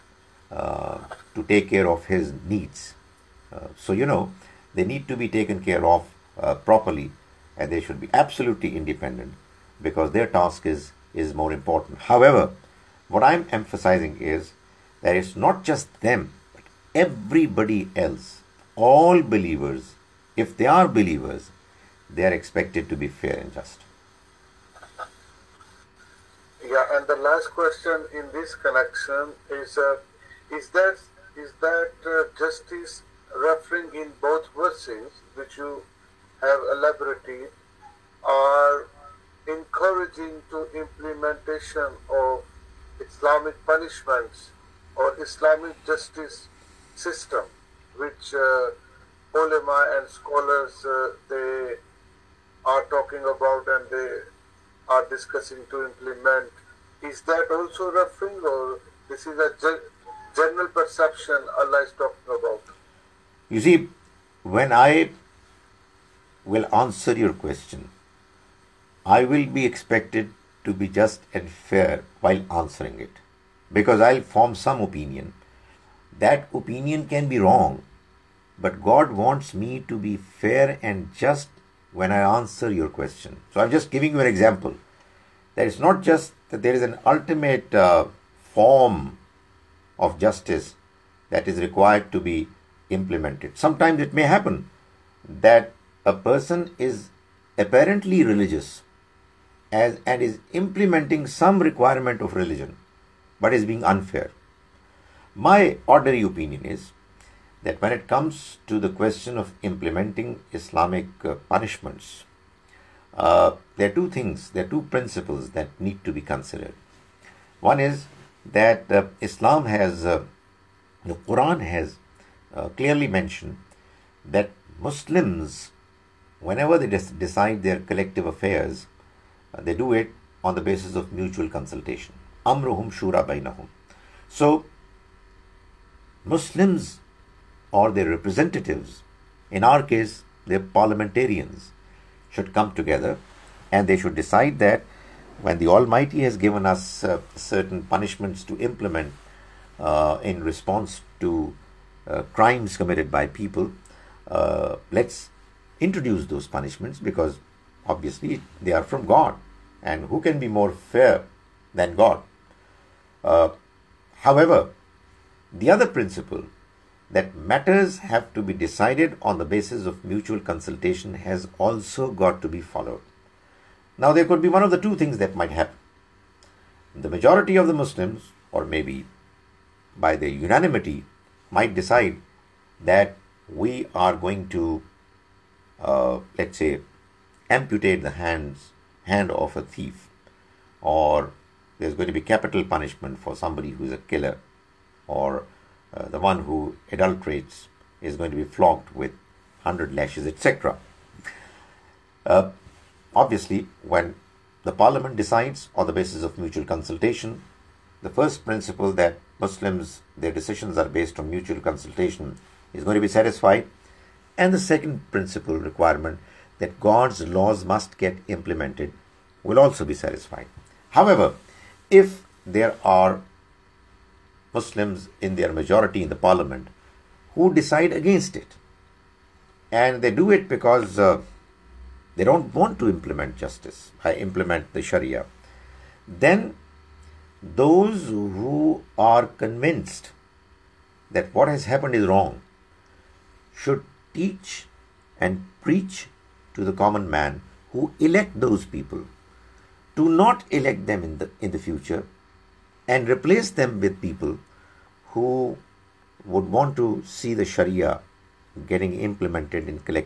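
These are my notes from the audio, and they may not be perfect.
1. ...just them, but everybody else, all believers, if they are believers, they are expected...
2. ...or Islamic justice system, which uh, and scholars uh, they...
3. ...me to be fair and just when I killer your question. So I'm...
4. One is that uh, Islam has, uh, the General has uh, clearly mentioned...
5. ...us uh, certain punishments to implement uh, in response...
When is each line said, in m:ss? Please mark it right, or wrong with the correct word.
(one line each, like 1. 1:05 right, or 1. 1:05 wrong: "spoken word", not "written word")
1. 0:15 right
2. 0:44 right
3. 1:19 wrong: "answer", not "killer"
4. 1:57 wrong: "Quran", not "General"
5. 2:26 right.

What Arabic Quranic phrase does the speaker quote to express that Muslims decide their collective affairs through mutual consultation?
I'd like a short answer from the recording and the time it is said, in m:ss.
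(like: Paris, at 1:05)
Amruhum shura bainahum, at 2:12.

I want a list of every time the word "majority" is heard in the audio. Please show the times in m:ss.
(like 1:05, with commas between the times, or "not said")
2:57, 3:45.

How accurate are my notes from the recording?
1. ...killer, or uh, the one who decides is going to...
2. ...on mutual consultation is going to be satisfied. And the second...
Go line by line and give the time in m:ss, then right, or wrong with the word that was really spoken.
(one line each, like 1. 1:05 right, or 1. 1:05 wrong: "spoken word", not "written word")
1. 3:13 wrong: "adulterates", not "decides"
2. 3:31 right.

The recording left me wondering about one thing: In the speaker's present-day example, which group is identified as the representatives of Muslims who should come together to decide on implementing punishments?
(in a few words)
parliamentarians.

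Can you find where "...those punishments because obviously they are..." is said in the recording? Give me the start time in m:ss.
2:36.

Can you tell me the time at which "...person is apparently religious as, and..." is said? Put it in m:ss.
1:36.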